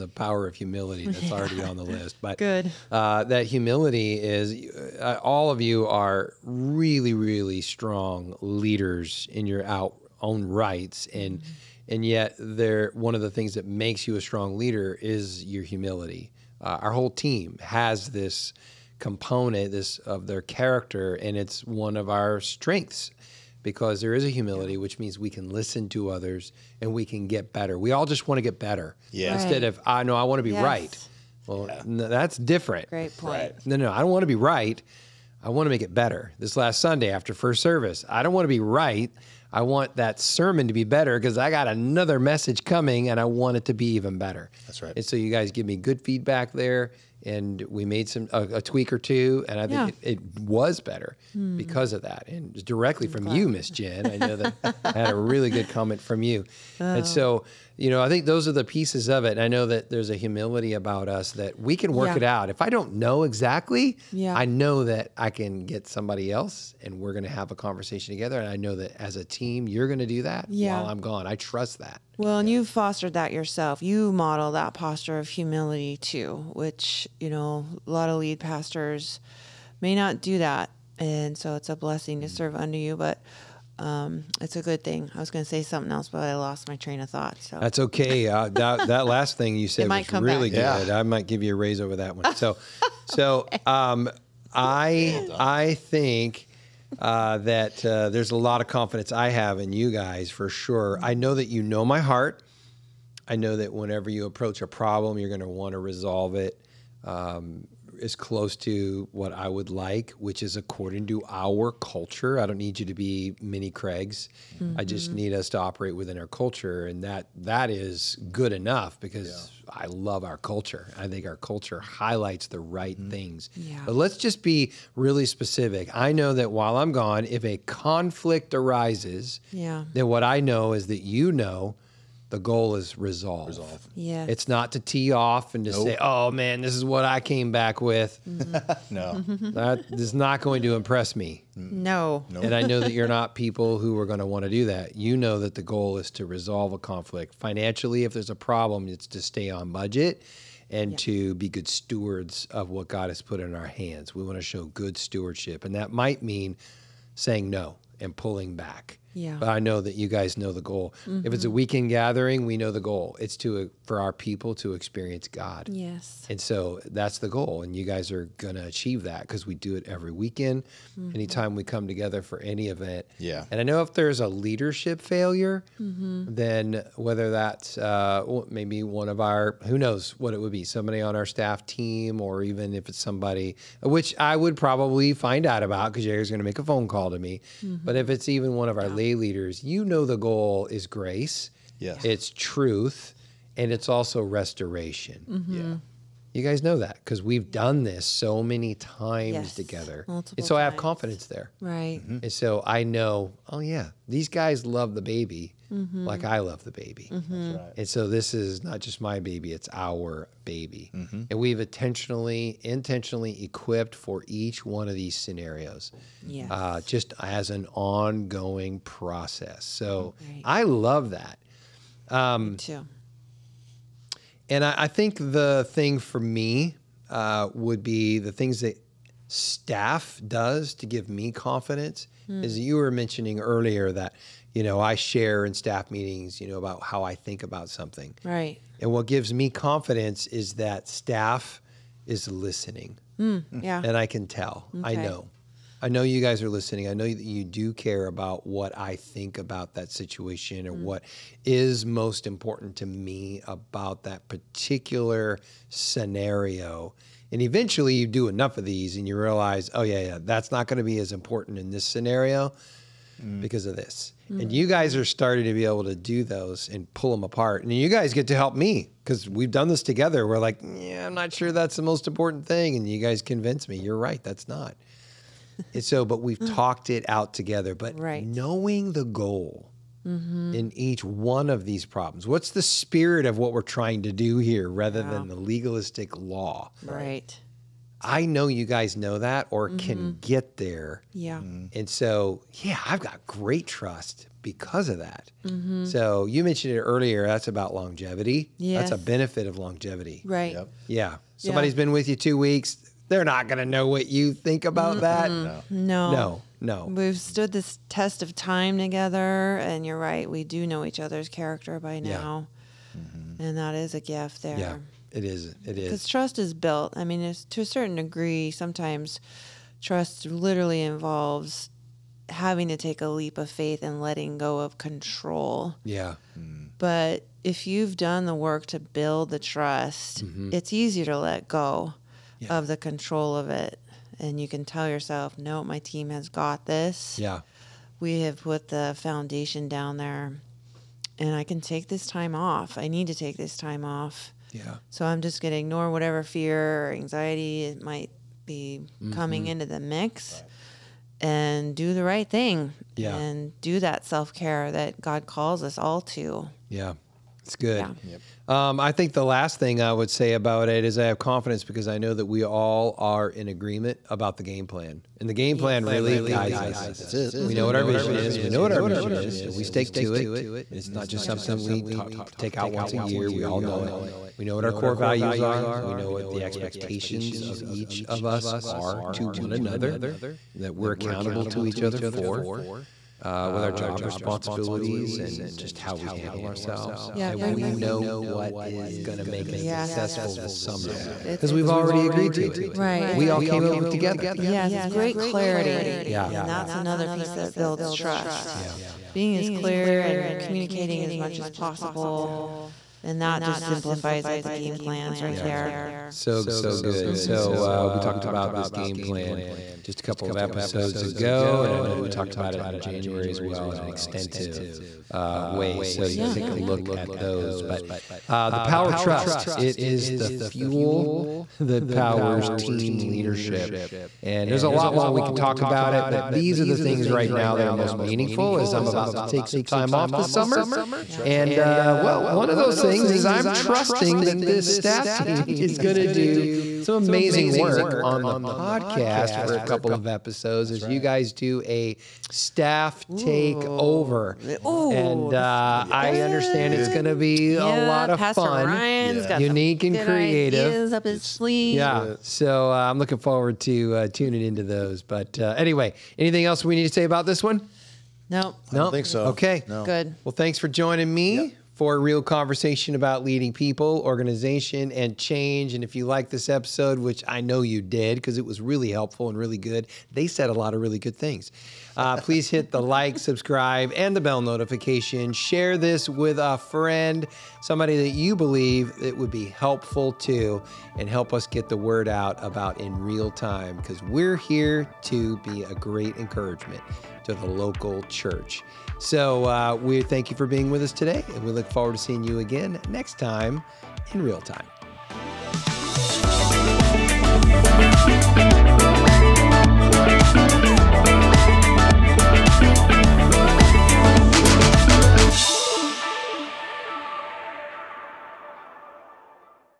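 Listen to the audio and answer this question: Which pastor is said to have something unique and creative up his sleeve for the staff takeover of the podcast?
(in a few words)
Ryan.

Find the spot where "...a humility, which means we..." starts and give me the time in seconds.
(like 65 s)
24 s.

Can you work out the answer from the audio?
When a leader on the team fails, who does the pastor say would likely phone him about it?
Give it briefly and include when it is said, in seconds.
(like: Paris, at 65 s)
Jerry, at 186 s.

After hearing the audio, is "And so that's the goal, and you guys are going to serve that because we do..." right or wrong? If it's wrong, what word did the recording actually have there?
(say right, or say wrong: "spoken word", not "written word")
wrong: "achieve", not "serve".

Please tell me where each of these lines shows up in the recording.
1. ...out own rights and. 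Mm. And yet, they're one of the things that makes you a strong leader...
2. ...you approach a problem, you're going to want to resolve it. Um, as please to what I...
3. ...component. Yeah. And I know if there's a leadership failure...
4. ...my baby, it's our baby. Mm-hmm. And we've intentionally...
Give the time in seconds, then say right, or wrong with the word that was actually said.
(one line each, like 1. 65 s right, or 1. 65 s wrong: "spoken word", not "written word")
1. 9 s right
2. 104 s wrong: "close", not "please"
3. 172 s wrong: "event", not "component"
4. 209 s right.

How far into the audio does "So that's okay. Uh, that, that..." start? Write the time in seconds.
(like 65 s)
87 s.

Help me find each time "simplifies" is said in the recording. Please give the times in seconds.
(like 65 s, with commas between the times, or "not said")
403 s.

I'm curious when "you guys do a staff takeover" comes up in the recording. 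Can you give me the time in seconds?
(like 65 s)
440 s.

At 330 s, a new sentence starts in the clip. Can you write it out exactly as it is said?
it's easier to let go yeah.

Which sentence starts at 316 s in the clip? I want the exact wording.
I mean, to a certain degree, sometimes trust literally involves having to take a leap of faith and letting go of control.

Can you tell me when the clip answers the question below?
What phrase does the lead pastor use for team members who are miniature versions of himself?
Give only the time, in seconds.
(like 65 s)
113 s.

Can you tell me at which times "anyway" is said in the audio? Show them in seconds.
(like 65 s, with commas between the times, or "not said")
455 s.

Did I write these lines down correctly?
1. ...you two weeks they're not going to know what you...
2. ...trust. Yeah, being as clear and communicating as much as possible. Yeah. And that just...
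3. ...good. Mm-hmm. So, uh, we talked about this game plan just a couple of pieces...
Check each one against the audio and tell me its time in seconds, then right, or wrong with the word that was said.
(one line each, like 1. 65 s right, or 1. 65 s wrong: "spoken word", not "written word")
1. 302 s right
2. 397 s right
3. 406 s wrong: "episodes", not "pieces".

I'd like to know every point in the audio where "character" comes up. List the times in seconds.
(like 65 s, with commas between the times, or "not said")
20 s, 311 s.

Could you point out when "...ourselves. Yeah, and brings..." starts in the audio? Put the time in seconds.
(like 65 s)
386 s.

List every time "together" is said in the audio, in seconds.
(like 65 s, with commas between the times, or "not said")
68 s, 171 s, 199 s, 269 s, 277 s, 308 s, 393 s.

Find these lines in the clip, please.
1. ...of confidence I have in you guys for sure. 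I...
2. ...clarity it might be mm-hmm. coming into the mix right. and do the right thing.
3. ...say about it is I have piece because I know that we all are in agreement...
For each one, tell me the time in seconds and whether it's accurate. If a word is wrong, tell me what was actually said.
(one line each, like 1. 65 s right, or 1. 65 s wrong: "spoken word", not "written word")
1. 98 s right
2. 346 s wrong: "anxiety", not "clarity"
3. 360 s wrong: "confidence", not "piece".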